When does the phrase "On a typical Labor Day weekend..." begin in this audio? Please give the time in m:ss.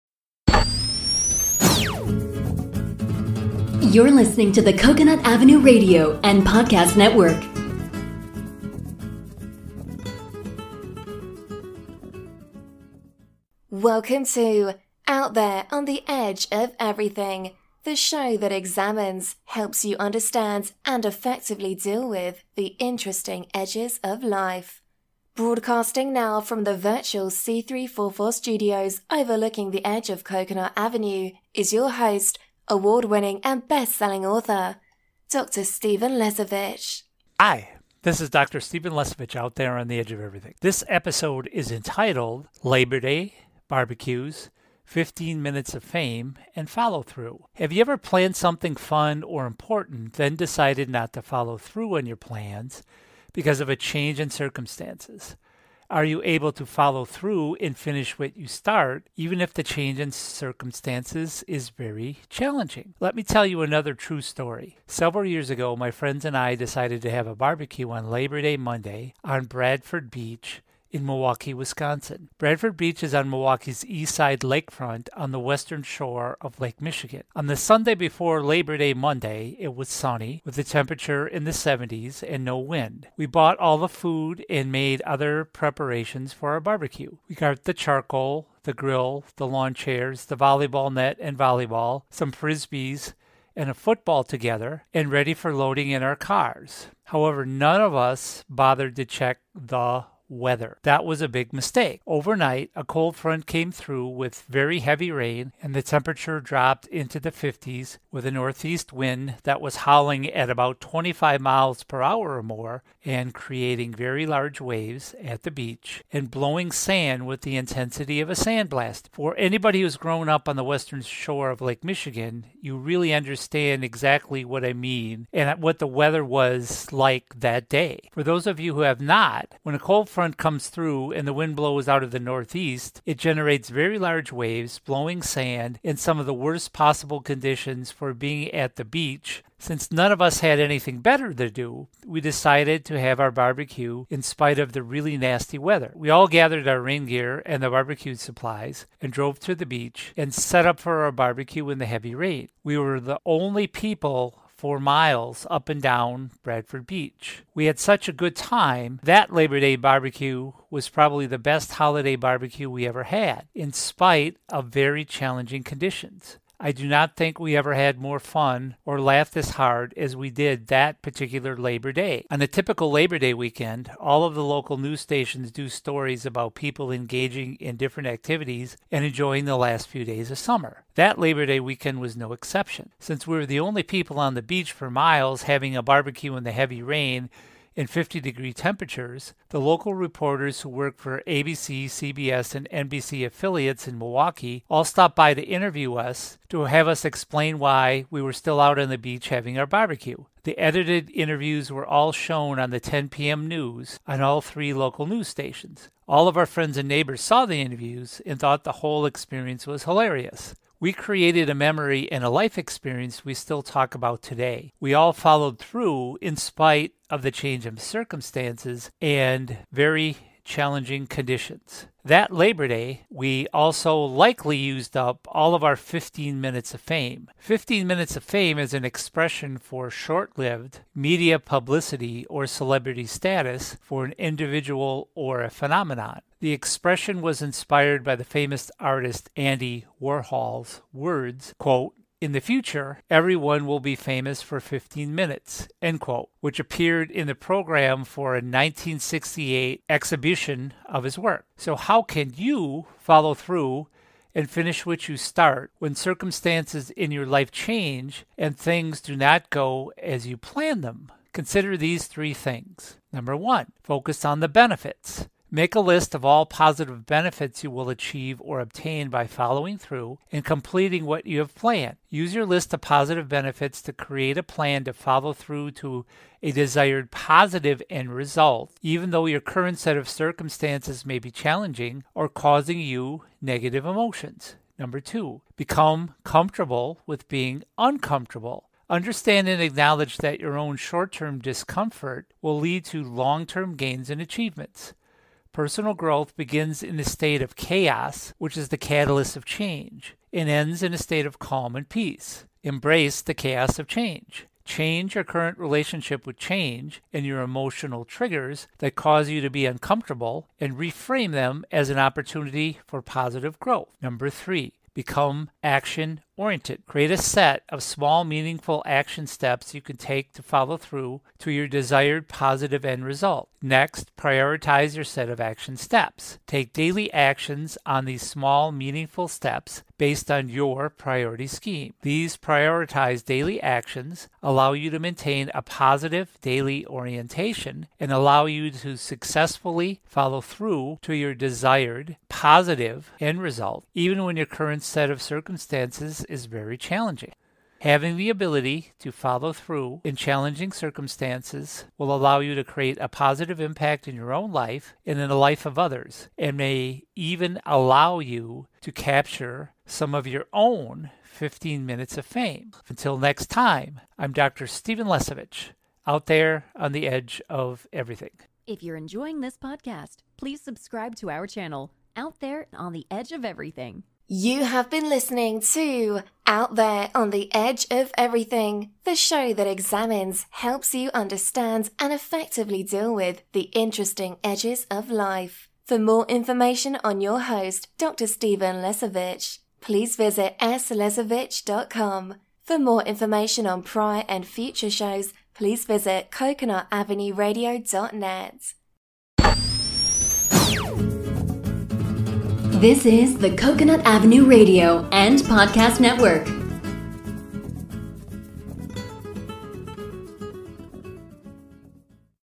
2:52.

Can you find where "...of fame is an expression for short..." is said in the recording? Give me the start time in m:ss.
3:48.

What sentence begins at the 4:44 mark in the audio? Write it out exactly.
Number two, become comfortable with being uncomfortable.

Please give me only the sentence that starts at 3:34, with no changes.
We all followed through in spite of the change of circumstances and very challenging conditions.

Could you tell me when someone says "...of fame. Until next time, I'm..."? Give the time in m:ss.
6:02.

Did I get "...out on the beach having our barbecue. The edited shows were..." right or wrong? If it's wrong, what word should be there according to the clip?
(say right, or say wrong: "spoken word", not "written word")
wrong: "interviews", not "shows".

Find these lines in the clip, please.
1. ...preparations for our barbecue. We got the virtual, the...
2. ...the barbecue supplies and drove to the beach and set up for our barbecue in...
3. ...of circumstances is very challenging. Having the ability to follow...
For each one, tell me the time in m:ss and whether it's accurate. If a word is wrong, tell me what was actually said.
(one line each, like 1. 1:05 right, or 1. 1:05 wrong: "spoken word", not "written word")
1. 1:25 wrong: "charcoal", not "virtual"
2. 2:27 right
3. 5:45 right.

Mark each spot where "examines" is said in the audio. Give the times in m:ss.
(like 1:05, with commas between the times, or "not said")
0:18, 6:19.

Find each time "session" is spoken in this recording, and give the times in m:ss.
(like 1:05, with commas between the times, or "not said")
not said.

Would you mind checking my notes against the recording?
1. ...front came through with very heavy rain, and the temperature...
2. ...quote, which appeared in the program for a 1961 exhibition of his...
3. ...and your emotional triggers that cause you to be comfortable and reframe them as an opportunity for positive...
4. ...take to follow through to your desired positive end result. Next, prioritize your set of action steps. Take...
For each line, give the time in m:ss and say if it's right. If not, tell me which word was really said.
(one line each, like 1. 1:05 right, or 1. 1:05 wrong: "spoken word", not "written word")
1. 1:43 right
2. 4:05 wrong: "1968", not "1961"
3. 5:07 wrong: "uncomfortable", not "comfortable"
4. 5:19 right.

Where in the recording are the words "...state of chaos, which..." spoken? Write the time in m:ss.
4:57.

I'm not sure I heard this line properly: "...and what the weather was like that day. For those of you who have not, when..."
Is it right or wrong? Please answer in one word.
right.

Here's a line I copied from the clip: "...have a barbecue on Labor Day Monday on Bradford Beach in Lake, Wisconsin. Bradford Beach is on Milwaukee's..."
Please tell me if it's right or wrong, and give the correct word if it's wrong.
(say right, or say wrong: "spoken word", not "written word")
wrong: "Milwaukee", not "Lake".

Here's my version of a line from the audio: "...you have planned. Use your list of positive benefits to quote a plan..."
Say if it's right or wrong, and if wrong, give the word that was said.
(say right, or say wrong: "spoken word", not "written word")
wrong: "create", not "quote".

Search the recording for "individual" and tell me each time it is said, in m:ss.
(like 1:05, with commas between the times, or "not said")
3:54.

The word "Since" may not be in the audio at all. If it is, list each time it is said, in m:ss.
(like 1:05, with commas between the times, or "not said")
2:19, 3:02.